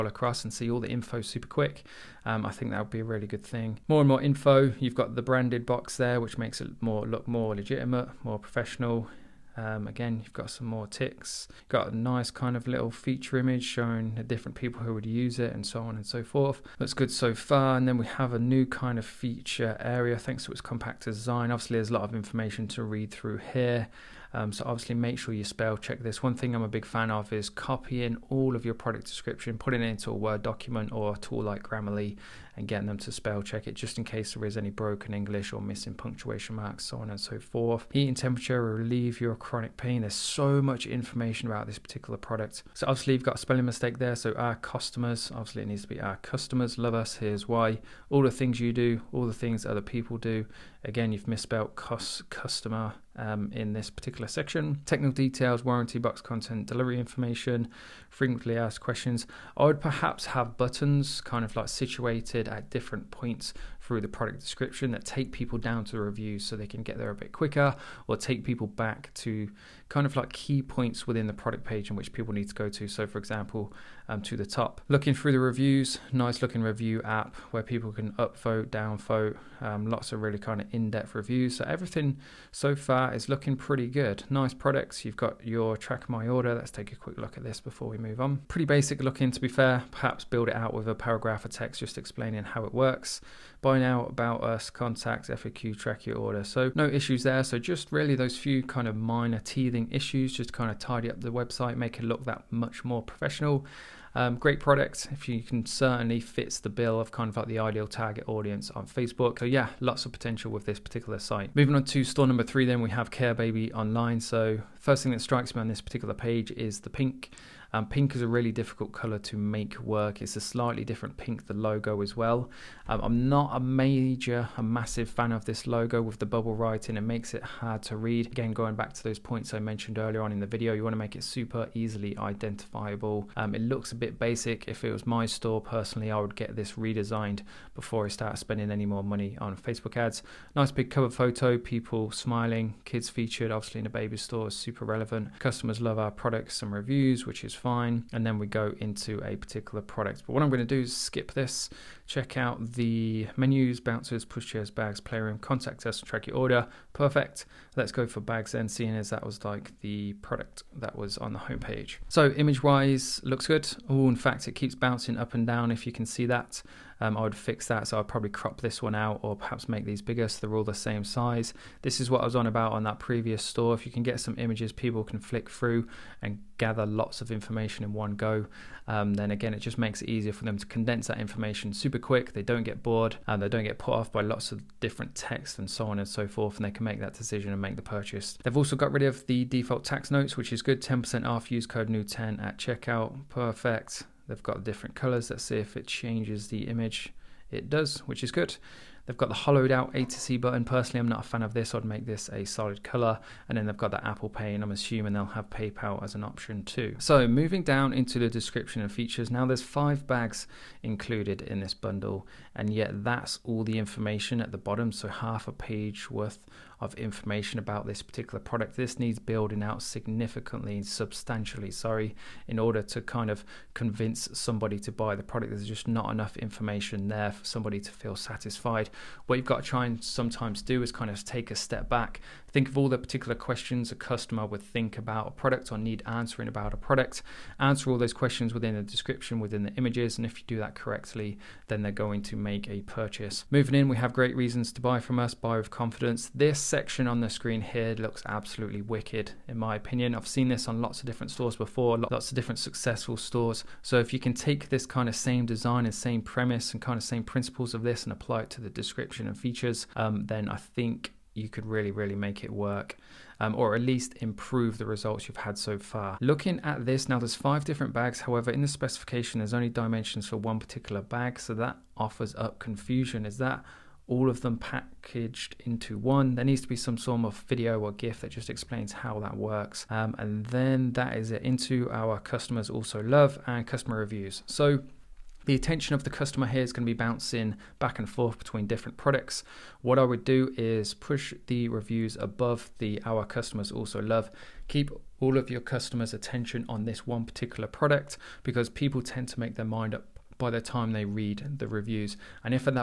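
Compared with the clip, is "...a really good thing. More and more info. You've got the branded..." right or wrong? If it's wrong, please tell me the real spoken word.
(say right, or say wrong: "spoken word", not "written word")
right.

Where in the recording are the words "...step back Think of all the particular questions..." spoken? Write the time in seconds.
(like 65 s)
231 s.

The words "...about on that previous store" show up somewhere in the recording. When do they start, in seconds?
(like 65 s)
172 s.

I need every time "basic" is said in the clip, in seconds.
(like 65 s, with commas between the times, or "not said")
88 s, 134 s.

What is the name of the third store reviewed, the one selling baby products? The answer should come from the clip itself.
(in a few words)
Care Baby Online.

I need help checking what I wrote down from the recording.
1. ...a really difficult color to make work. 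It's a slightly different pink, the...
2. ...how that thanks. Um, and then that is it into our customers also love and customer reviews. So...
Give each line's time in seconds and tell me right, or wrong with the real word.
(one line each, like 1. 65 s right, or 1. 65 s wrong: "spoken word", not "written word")
1. 118 s right
2. 278 s wrong: "works", not "thanks".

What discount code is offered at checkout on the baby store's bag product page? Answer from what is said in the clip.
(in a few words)
new10.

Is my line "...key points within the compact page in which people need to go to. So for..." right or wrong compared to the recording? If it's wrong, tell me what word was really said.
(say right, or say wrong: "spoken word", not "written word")
wrong: "product", not "compact".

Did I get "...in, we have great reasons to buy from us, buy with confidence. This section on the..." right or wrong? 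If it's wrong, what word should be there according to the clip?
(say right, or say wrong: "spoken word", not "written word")
right.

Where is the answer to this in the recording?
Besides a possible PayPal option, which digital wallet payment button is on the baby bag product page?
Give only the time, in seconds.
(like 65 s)
204 s.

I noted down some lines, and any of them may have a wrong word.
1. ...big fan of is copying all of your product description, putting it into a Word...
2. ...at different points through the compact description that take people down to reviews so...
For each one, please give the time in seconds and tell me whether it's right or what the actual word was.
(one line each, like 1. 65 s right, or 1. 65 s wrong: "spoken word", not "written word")
1. 26 s right
2. 62 s wrong: "product", not "compact".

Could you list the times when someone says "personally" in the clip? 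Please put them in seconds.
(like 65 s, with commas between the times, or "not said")
135 s, 200 s.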